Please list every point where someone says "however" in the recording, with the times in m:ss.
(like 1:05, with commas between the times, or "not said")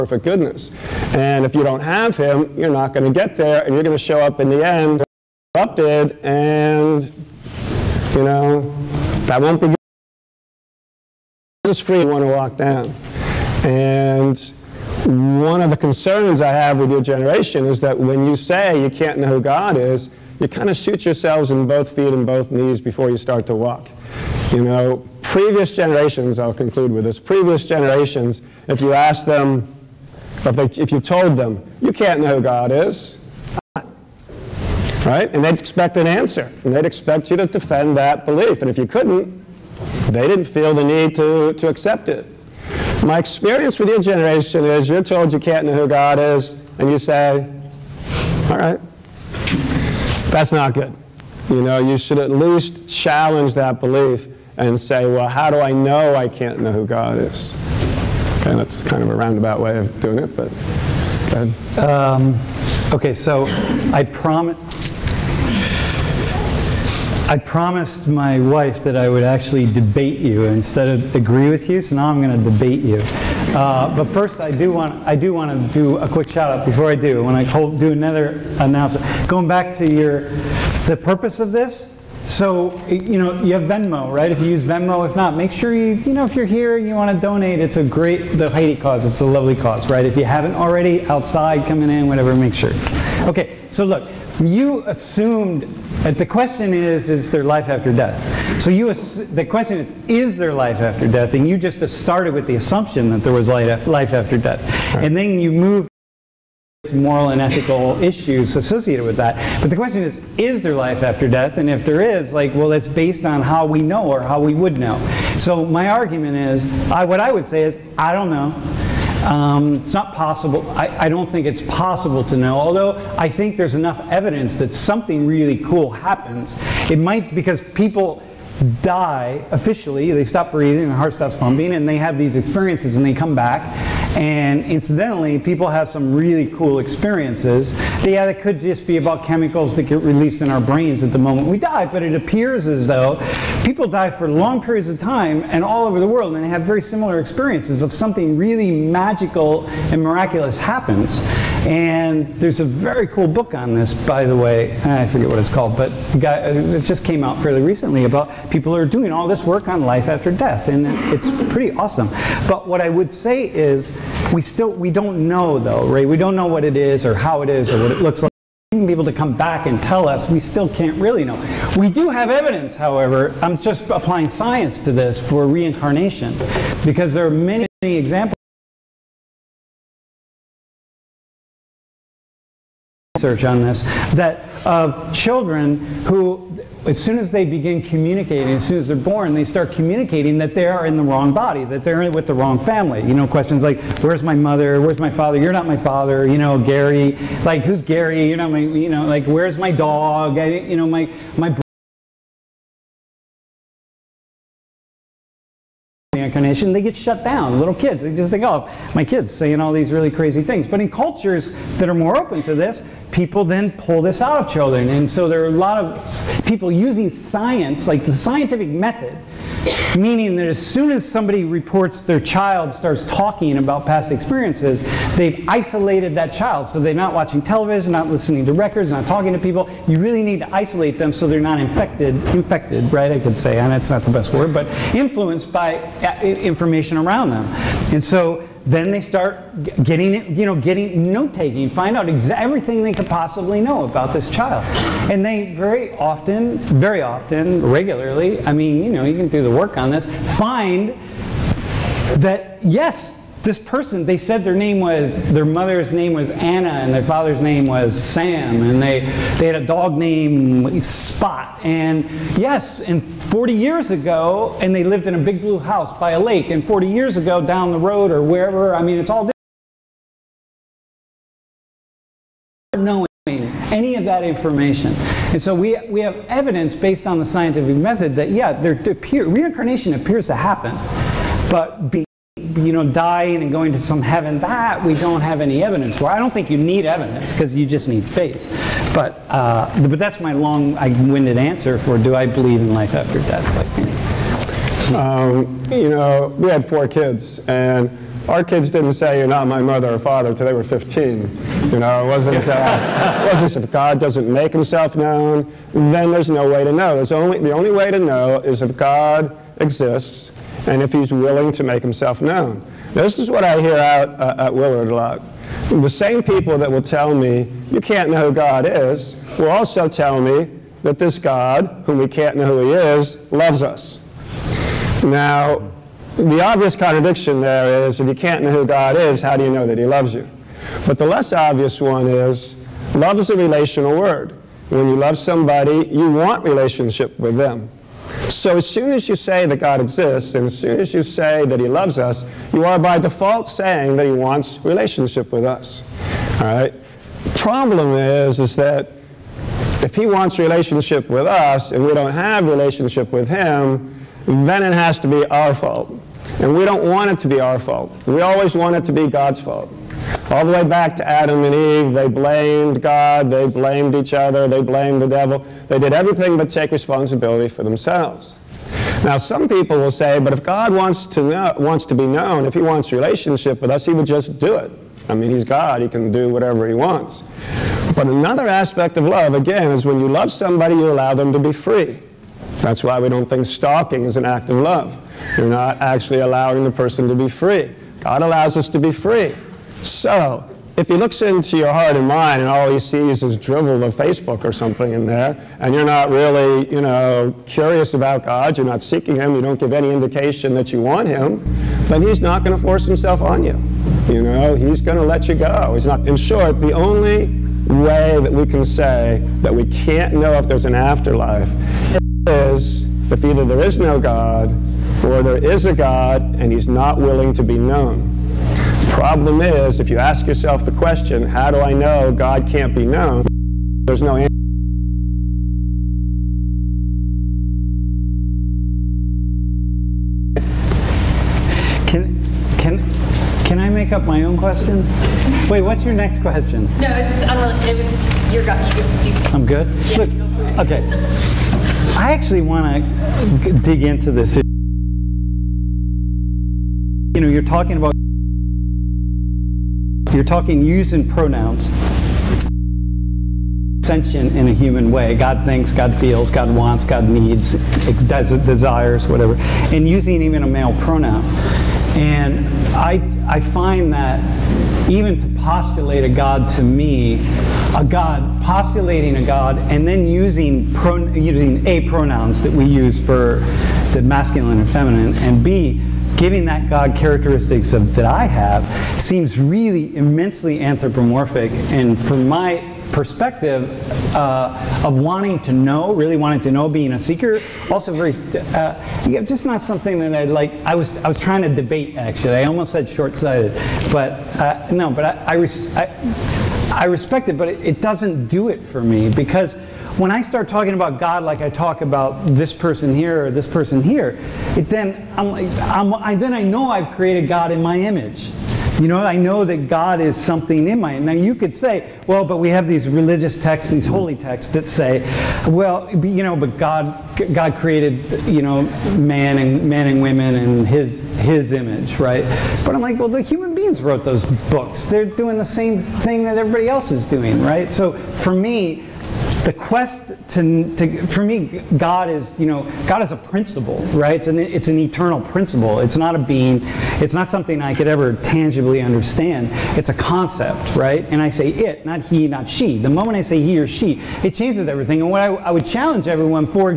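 2:52.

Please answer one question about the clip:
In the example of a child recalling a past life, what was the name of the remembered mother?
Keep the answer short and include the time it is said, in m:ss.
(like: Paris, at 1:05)
Anna, at 4:16.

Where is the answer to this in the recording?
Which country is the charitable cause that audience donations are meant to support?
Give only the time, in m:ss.
1:28.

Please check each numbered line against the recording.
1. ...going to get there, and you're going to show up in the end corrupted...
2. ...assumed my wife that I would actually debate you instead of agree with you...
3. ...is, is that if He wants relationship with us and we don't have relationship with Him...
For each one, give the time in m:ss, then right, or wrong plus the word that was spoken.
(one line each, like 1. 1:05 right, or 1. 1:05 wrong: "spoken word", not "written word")
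1. 0:02 right
2. 1:07 wrong: "promised", not "assumed"
3. 5:47 right.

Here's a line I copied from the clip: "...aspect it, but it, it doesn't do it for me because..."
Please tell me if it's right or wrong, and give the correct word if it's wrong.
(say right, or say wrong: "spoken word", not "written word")
wrong: "respect", not "aspect".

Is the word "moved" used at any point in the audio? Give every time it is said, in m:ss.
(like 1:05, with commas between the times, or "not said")
1:45.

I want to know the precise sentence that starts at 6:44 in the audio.
You know, he's going to let you go.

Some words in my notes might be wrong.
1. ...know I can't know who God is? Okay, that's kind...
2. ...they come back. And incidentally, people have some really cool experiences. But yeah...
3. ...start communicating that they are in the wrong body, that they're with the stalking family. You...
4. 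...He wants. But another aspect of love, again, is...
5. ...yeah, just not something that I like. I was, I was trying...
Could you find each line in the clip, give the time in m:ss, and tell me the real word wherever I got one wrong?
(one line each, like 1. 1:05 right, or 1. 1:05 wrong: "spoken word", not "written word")
1. 0:55 right
2. 2:13 right
3. 3:09 wrong: "wrong", not "stalking"
4. 6:16 right
5. 8:09 right.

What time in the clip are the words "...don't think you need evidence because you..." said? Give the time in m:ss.
4:46.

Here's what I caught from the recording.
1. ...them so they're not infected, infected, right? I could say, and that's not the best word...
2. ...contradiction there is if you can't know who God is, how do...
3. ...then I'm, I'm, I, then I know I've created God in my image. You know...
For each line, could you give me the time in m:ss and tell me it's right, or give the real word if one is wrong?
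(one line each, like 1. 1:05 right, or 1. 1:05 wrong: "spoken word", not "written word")
1. 3:50 right
2. 5:26 right
3. 8:24 right.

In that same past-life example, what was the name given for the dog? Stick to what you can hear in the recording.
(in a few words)
Spot.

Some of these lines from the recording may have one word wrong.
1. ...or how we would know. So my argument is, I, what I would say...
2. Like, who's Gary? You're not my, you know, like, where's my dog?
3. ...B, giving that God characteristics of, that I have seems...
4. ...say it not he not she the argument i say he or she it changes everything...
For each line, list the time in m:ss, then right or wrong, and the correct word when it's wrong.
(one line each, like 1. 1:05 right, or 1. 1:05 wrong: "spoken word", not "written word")
1. 1:54 right
2. 3:17 right
3. 7:55 right
4. 9:01 wrong: "moment", not "argument".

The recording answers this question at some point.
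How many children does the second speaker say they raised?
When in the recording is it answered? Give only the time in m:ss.
4:56.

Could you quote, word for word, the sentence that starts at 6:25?
You're not actually allowing the person to be free.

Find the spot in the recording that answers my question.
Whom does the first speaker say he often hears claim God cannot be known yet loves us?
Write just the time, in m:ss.
5:14.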